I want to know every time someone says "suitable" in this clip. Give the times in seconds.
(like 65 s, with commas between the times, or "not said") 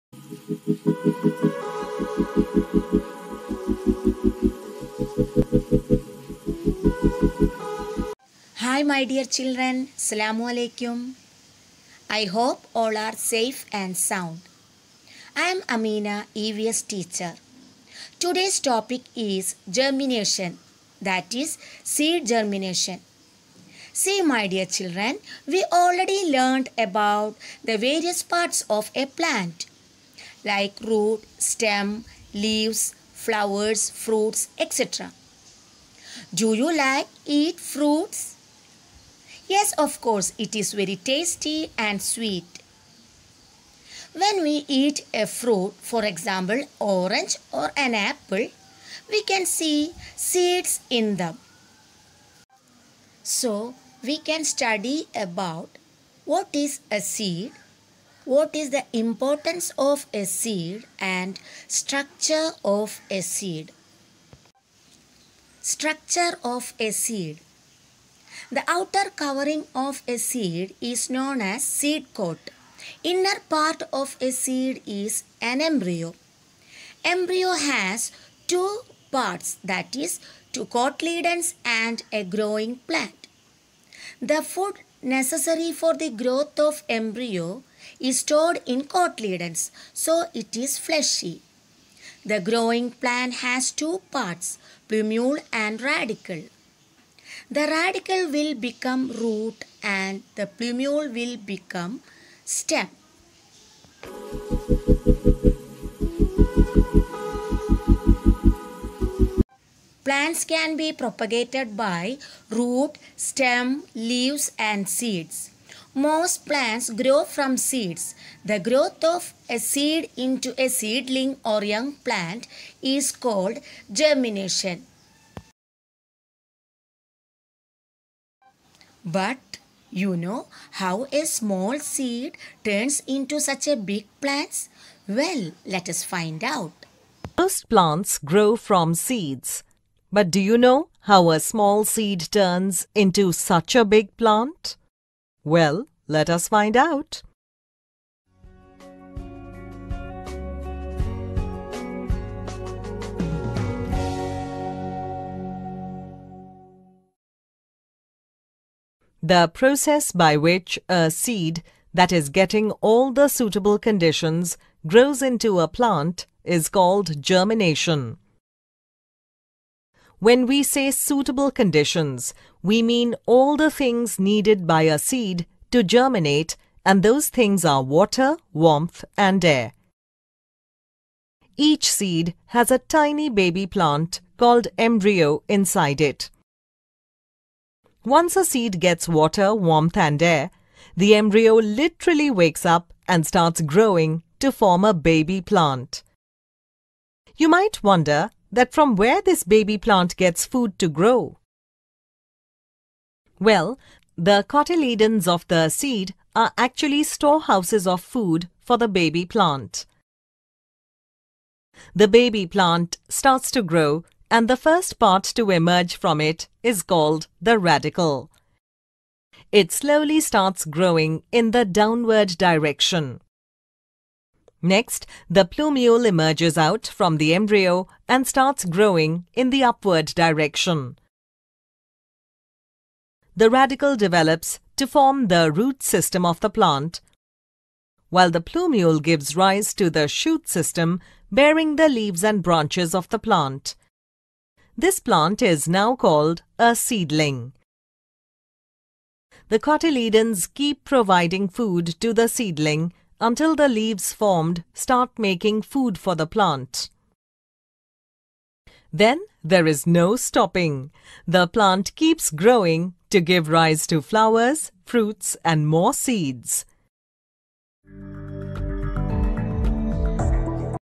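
163 s, 170 s.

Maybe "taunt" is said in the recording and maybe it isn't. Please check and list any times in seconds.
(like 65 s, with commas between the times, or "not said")
not said.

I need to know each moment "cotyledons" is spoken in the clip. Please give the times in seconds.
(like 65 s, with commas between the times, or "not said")
80 s, 88 s, 204 s, 249 s.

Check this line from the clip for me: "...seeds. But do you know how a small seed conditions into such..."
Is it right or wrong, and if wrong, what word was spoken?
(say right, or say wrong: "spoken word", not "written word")
wrong: "turns", not "conditions".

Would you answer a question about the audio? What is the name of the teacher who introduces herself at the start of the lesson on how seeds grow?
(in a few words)
Amina.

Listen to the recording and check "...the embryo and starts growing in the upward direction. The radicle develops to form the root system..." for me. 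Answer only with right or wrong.
right.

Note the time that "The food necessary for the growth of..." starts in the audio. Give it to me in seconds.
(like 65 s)
84 s.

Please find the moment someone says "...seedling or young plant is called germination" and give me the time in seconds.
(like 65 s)
120 s.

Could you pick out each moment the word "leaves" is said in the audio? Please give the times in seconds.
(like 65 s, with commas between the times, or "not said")
32 s, 113 s, 241 s, 253 s.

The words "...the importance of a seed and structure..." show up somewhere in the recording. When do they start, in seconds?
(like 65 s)
58 s.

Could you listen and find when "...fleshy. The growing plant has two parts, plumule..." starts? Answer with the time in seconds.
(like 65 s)
90 s.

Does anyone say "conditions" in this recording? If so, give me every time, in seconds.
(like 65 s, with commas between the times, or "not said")
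163 s, 171 s.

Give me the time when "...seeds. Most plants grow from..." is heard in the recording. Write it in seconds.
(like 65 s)
114 s.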